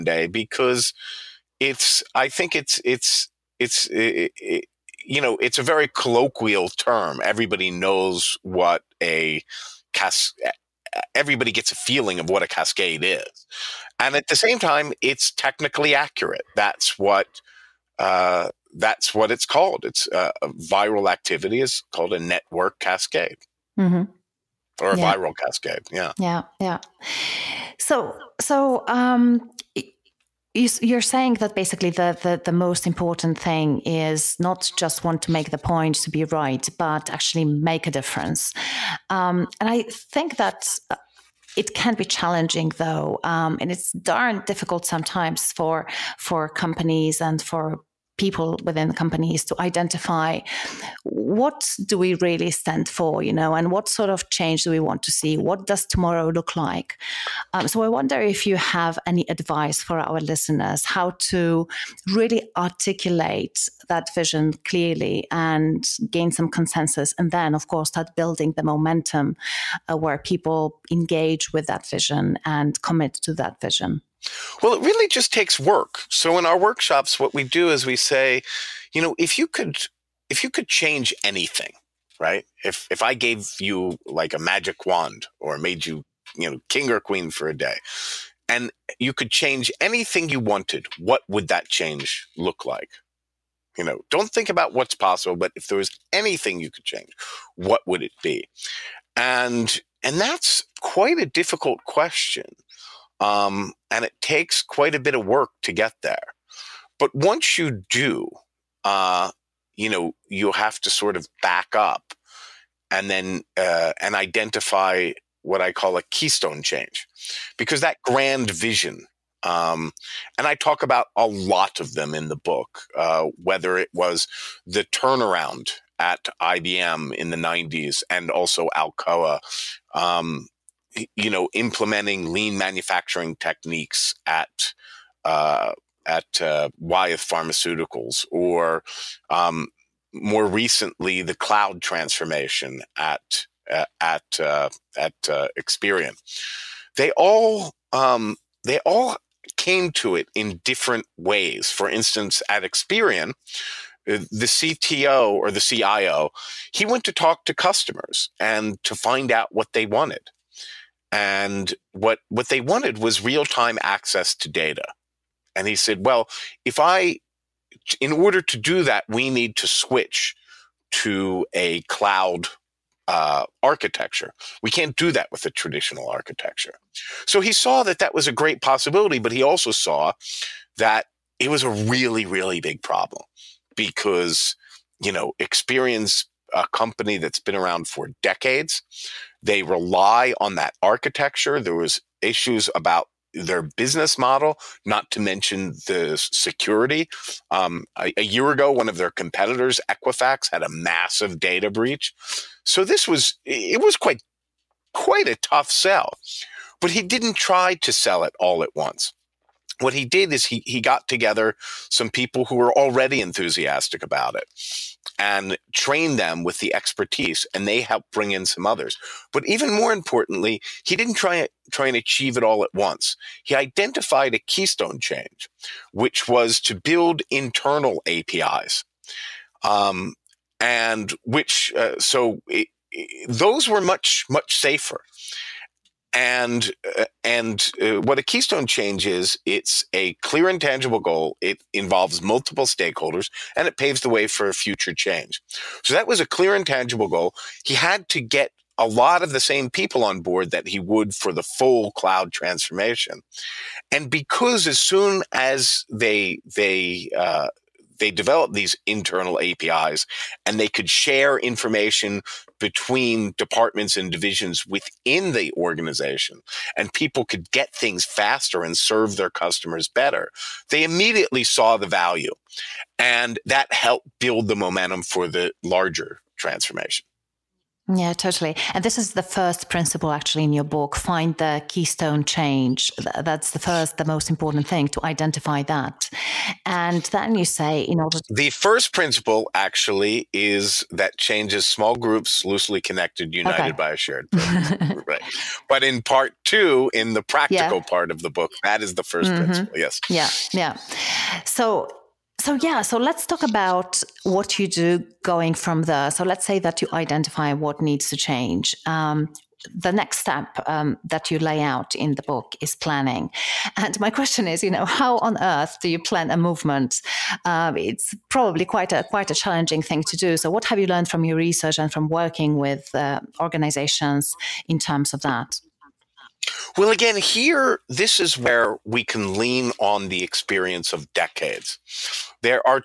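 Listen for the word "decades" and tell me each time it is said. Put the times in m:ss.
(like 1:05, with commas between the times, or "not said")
3:08, 5:31.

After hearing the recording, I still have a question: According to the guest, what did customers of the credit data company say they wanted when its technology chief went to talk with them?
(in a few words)
real time access to data.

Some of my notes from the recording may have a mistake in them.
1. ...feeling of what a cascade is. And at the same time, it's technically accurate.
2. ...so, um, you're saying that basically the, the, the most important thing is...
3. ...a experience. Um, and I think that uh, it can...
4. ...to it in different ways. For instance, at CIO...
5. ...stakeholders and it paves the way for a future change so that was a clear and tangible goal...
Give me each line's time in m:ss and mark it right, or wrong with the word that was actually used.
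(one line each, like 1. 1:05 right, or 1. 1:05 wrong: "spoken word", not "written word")
1. 0:11 right
2. 0:28 right
3. 0:37 wrong: "difference", not "experience"
4. 2:29 wrong: "Experian", not "CIO"
5. 4:02 right.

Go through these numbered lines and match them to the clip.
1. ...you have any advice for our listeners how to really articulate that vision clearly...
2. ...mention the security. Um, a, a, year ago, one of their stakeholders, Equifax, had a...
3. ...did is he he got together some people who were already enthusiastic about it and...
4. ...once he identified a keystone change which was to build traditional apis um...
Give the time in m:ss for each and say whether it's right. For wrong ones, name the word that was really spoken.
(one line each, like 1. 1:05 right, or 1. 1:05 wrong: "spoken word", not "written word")
1. 0:58 right
2. 3:15 wrong: "competitors", not "stakeholders"
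3. 3:30 right
4. 3:42 wrong: "internal", not "traditional".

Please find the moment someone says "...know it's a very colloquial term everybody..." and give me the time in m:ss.
0:05.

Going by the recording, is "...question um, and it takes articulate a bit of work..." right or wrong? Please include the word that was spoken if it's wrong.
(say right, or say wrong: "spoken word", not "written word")
wrong: "quite", not "articulate".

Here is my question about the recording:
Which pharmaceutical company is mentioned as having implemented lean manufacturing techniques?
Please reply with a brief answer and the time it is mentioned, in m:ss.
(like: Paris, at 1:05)
Wyeth Pharmaceuticals, at 2:16.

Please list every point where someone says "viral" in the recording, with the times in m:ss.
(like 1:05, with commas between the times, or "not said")
0:20, 0:25.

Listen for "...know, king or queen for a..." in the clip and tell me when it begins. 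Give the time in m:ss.
1:26.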